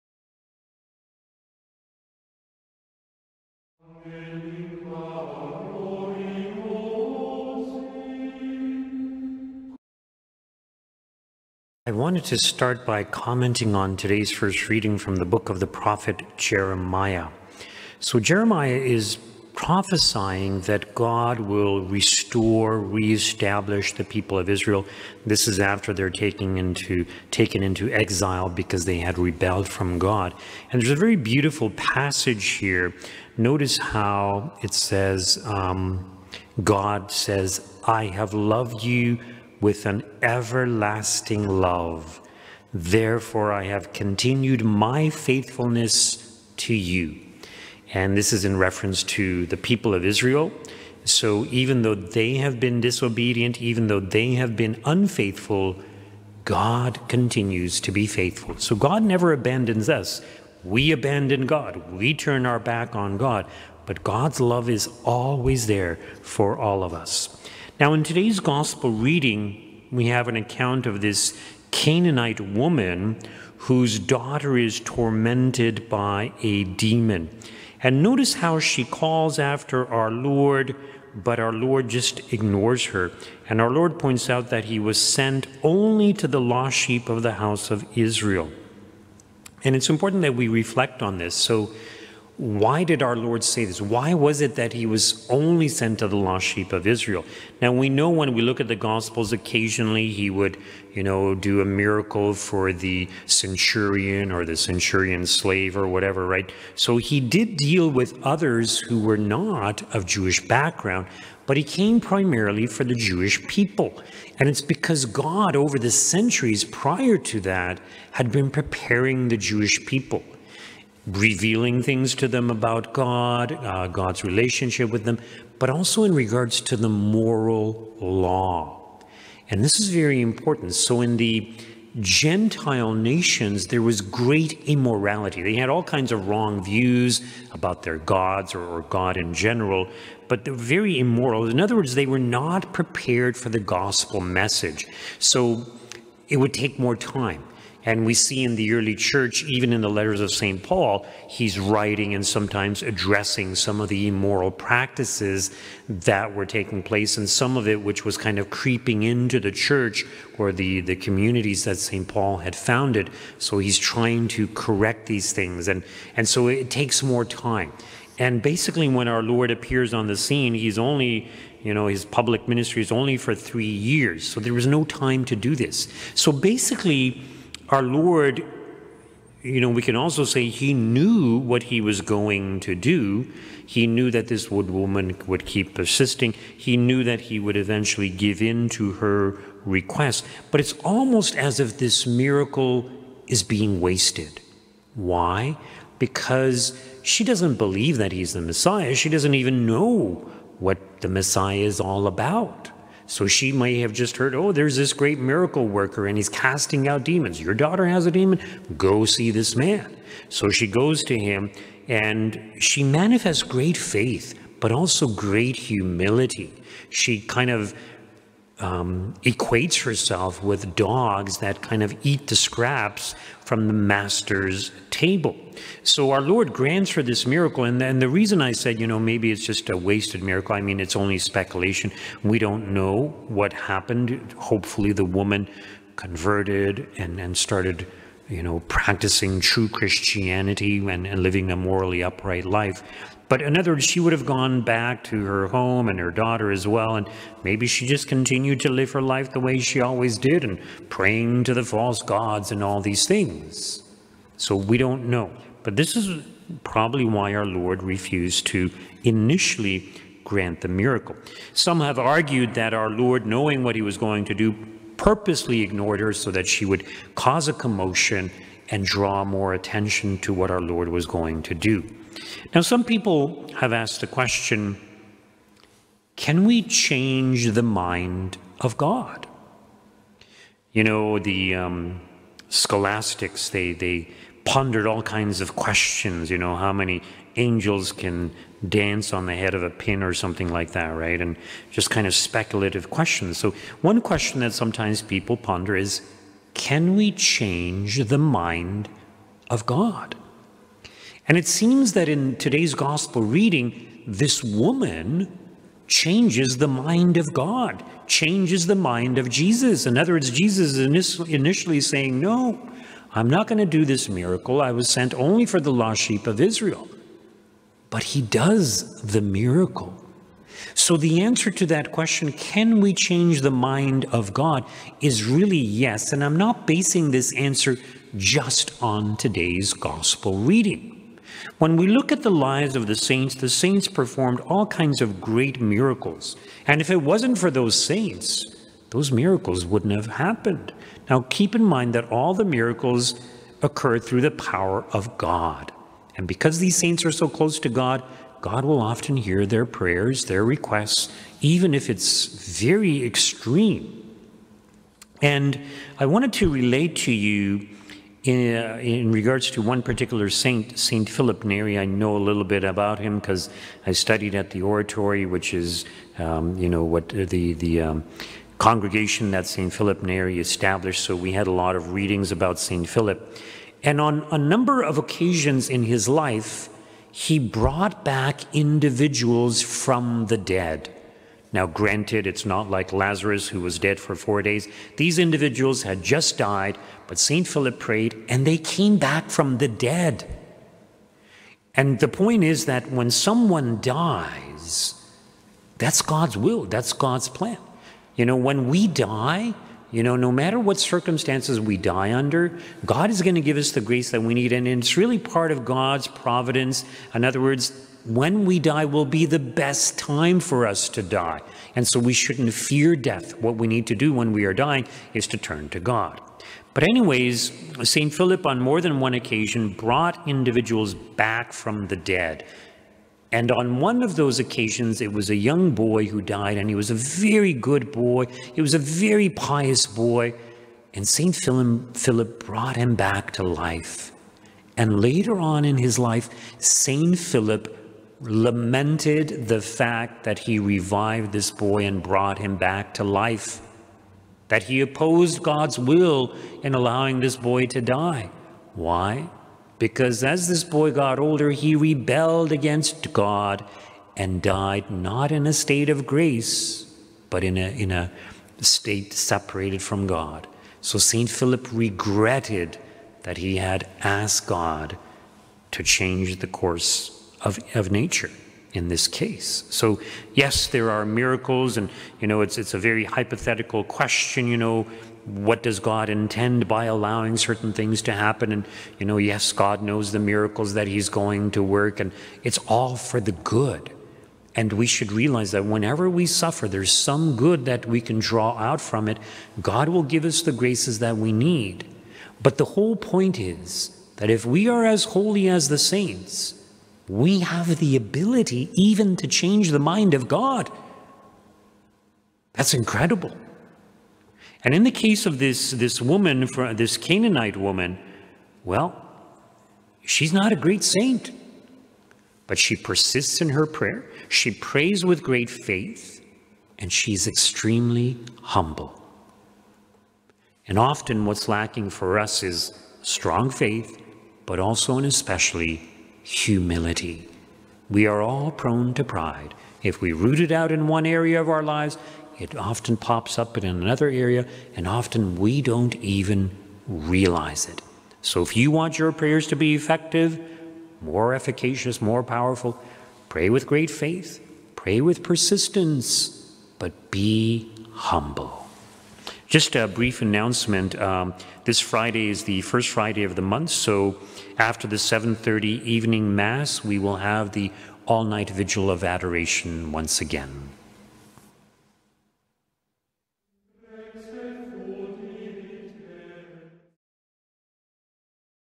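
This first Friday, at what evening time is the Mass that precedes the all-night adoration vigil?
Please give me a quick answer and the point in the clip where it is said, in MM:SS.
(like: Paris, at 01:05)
7:30, at 09:14.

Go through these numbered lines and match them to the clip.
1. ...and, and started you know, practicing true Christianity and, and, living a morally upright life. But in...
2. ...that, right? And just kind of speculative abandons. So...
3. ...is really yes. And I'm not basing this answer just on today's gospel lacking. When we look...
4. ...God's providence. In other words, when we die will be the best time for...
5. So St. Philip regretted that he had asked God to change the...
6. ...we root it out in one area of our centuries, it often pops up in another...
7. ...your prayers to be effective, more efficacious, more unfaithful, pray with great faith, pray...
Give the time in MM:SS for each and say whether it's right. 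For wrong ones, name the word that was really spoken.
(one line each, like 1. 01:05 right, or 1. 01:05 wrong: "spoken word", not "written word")
1. 03:56 right
2. 04:50 wrong: "questions", not "abandons"
3. 05:25 wrong: "reading", not "lacking"
4. 06:45 right
5. 07:40 right
6. 08:50 wrong: "lives", not "centuries"
7. 08:58 wrong: "powerful", not "unfaithful".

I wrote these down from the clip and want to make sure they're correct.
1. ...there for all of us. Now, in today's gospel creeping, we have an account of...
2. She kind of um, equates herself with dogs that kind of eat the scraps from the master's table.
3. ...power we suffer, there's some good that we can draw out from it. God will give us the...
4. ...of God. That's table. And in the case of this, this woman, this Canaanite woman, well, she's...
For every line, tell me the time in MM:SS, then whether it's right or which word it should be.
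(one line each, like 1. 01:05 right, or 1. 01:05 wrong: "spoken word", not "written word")
1. 01:05 wrong: "reading", not "creeping"
2. 03:36 right
3. 08:05 wrong: "whenever", not "power"
4. 08:20 wrong: "incredible", not "table".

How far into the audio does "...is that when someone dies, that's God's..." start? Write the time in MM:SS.
06:32.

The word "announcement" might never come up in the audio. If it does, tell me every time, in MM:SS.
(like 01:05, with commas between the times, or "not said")
09:10.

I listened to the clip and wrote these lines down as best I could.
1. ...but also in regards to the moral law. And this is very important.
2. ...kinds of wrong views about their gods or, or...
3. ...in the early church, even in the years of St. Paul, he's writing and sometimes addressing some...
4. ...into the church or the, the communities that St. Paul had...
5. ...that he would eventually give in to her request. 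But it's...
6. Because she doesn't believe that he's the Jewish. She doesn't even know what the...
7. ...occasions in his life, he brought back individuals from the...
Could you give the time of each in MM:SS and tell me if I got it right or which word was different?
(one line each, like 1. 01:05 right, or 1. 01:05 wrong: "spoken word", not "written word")
1. 02:05 right
2. 02:15 right
3. 02:28 wrong: "letters", not "years"
4. 02:39 right
5. 03:07 right
6. 03:15 wrong: "Messiah", not "Jewish"
7. 06:14 right.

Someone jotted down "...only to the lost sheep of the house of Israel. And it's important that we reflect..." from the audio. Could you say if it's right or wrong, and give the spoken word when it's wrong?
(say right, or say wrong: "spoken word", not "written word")
right.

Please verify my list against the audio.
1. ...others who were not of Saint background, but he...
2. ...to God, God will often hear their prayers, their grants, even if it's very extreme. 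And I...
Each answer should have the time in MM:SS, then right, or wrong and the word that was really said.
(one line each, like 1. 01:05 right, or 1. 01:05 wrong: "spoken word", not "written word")
1. 01:48 wrong: "Jewish", not "Saint"
2. 05:47 wrong: "requests", not "grants".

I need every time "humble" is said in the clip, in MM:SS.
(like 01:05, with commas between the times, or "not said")
08:38, 09:07.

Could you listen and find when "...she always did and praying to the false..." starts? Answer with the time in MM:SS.
04:09.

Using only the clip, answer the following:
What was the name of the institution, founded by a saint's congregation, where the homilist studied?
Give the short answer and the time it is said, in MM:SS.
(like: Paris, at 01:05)
the Oratory, at 06:04.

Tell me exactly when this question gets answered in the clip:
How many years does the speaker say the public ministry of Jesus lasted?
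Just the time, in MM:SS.
02:53.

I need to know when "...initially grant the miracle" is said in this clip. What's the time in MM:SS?
04:19.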